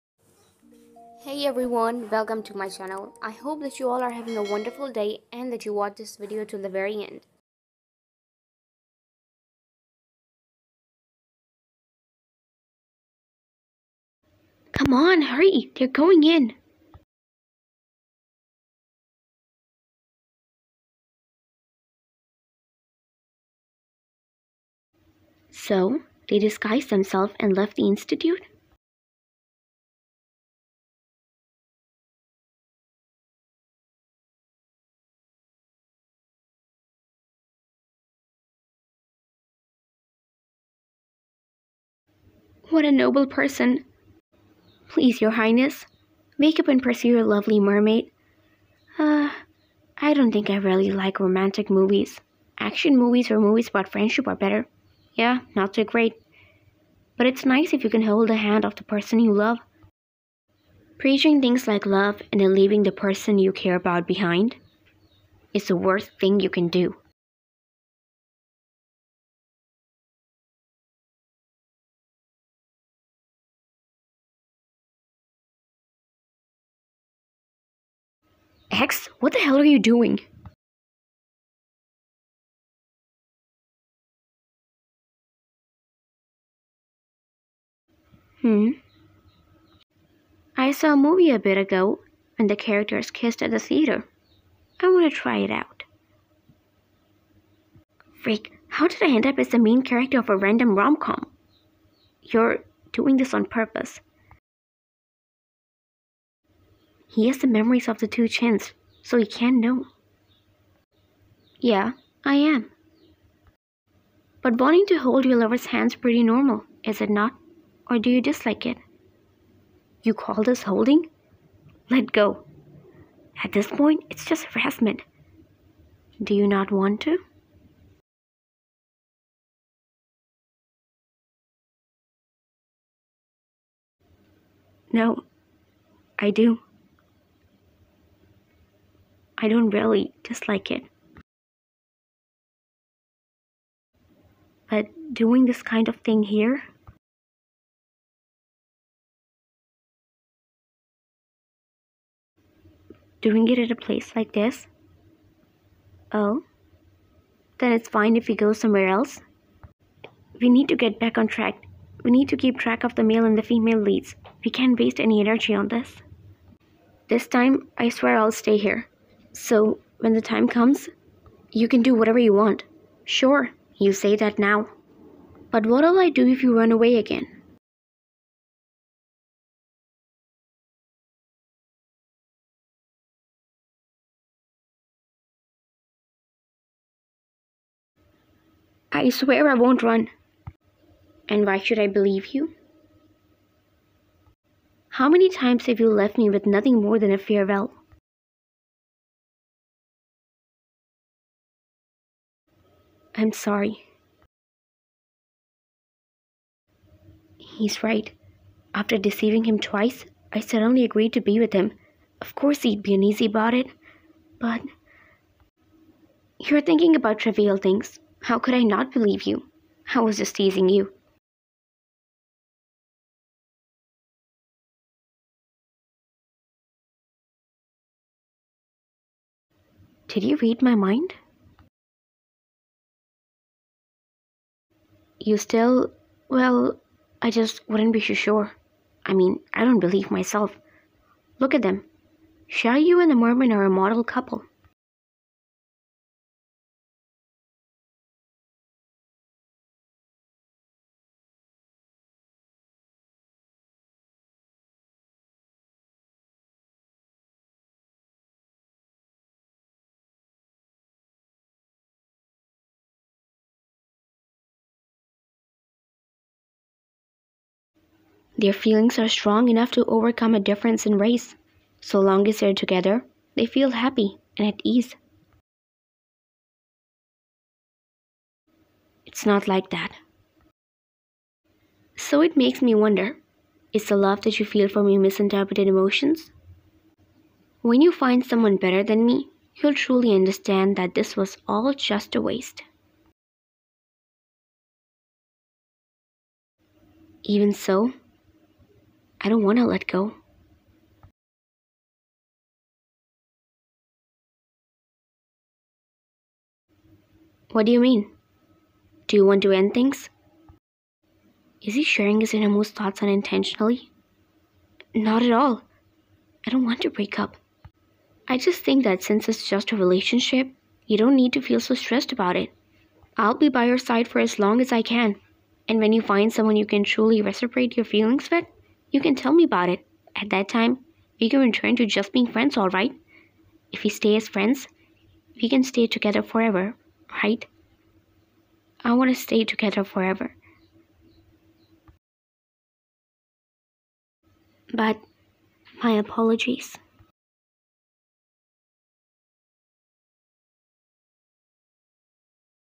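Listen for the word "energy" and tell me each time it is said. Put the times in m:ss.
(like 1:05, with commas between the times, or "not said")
2:45.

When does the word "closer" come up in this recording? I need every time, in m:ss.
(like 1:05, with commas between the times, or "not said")
not said.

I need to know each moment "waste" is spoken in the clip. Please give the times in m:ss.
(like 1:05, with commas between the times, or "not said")
2:44, 4:52.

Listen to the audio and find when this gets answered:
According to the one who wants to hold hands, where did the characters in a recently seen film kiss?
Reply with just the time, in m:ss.
1:33.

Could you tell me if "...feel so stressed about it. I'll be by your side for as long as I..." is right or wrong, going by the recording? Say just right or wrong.
right.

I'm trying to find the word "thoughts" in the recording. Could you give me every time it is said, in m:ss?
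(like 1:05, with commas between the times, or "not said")
5:12.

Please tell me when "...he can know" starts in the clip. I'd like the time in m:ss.
1:49.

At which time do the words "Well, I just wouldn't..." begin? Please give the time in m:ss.
3:56.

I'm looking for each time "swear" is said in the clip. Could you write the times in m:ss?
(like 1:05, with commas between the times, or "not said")
2:47, 3:09.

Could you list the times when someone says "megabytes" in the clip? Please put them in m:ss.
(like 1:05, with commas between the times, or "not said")
not said.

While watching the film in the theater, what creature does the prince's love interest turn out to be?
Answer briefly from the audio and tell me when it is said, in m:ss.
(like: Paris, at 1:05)
mermaid, at 0:47.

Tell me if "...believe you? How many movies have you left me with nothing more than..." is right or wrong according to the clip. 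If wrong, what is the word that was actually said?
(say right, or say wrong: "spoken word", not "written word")
wrong: "times", not "movies".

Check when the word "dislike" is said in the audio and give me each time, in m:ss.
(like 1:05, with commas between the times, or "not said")
1:58, 2:20.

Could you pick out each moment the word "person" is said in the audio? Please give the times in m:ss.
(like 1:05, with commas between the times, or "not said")
0:43, 0:58, 1:02.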